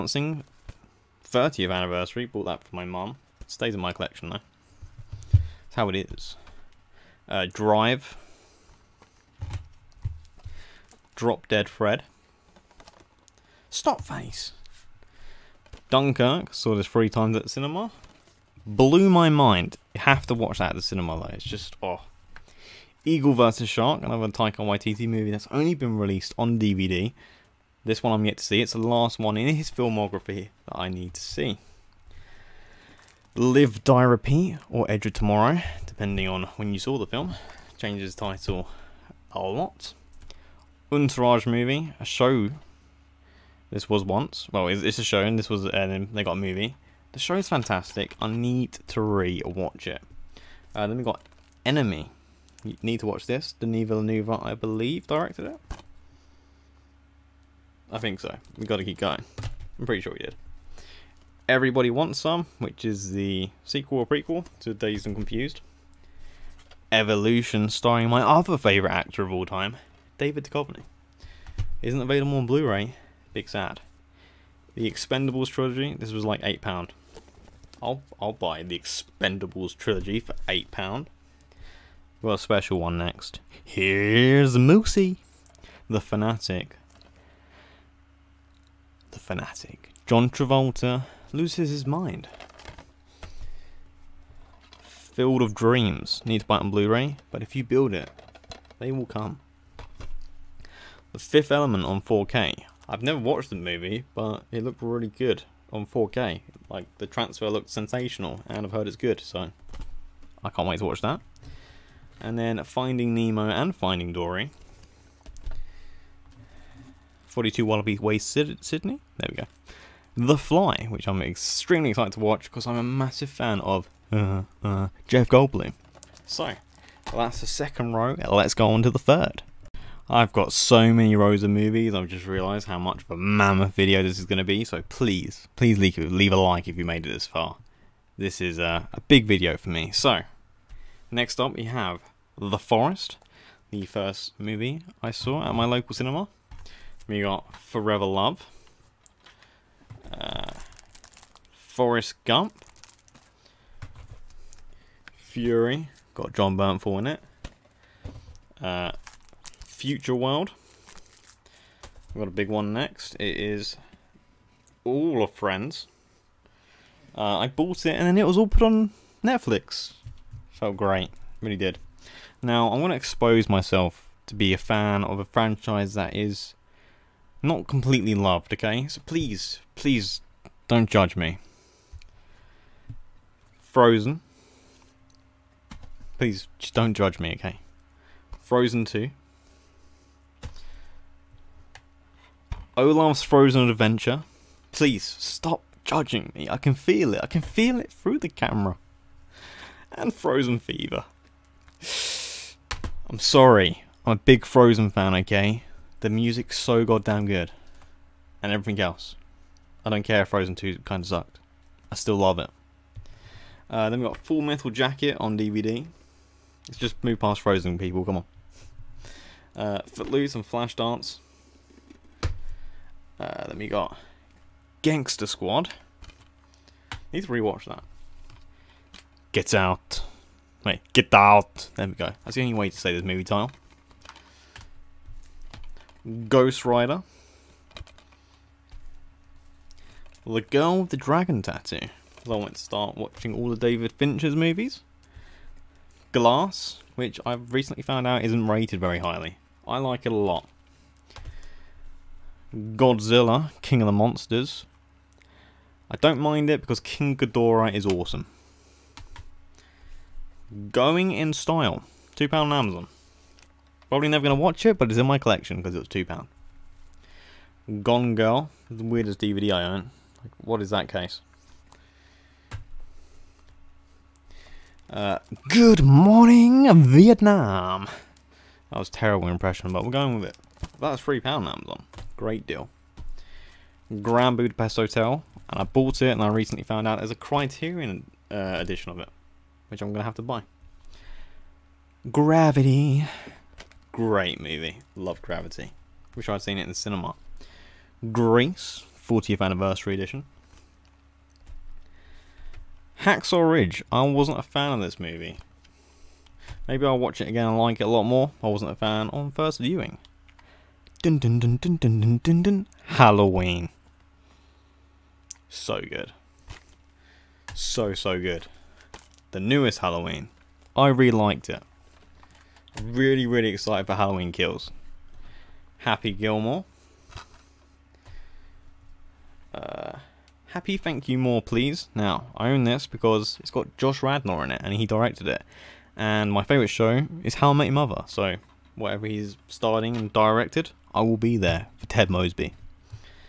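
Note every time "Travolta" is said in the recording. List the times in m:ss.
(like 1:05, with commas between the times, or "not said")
1:30.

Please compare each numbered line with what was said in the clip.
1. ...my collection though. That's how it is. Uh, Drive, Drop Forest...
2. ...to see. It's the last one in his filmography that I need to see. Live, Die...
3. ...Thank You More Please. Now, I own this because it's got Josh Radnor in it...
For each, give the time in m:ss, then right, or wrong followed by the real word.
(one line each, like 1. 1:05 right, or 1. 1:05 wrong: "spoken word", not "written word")
1. 0:03 wrong: "Dead", not "Forest"
2. 0:28 right
3. 5:30 right.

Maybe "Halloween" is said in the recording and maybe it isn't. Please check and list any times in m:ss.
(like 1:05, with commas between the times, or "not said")
5:12, 5:19, 5:23.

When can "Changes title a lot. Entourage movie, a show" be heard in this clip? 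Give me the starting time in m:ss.
0:37.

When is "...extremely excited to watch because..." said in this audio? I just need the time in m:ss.
2:01.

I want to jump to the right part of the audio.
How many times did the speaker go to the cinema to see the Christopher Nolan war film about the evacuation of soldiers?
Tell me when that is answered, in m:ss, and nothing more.
0:16.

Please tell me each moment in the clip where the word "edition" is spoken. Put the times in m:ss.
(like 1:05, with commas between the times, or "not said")
4:48, 4:59.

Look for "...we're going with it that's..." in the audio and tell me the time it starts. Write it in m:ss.
4:39.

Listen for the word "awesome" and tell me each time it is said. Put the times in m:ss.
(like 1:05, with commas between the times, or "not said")
4:17.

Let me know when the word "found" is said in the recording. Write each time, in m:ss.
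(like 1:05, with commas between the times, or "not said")
4:07, 4:46.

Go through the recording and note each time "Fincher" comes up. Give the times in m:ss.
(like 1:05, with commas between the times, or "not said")
4:03.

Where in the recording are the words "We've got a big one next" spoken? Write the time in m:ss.
2:42.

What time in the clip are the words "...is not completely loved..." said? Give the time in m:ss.
2:56.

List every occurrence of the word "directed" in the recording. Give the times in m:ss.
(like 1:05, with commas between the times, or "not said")
0:55, 5:34, 5:40.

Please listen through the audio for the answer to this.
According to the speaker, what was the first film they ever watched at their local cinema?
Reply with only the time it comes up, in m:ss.
2:22.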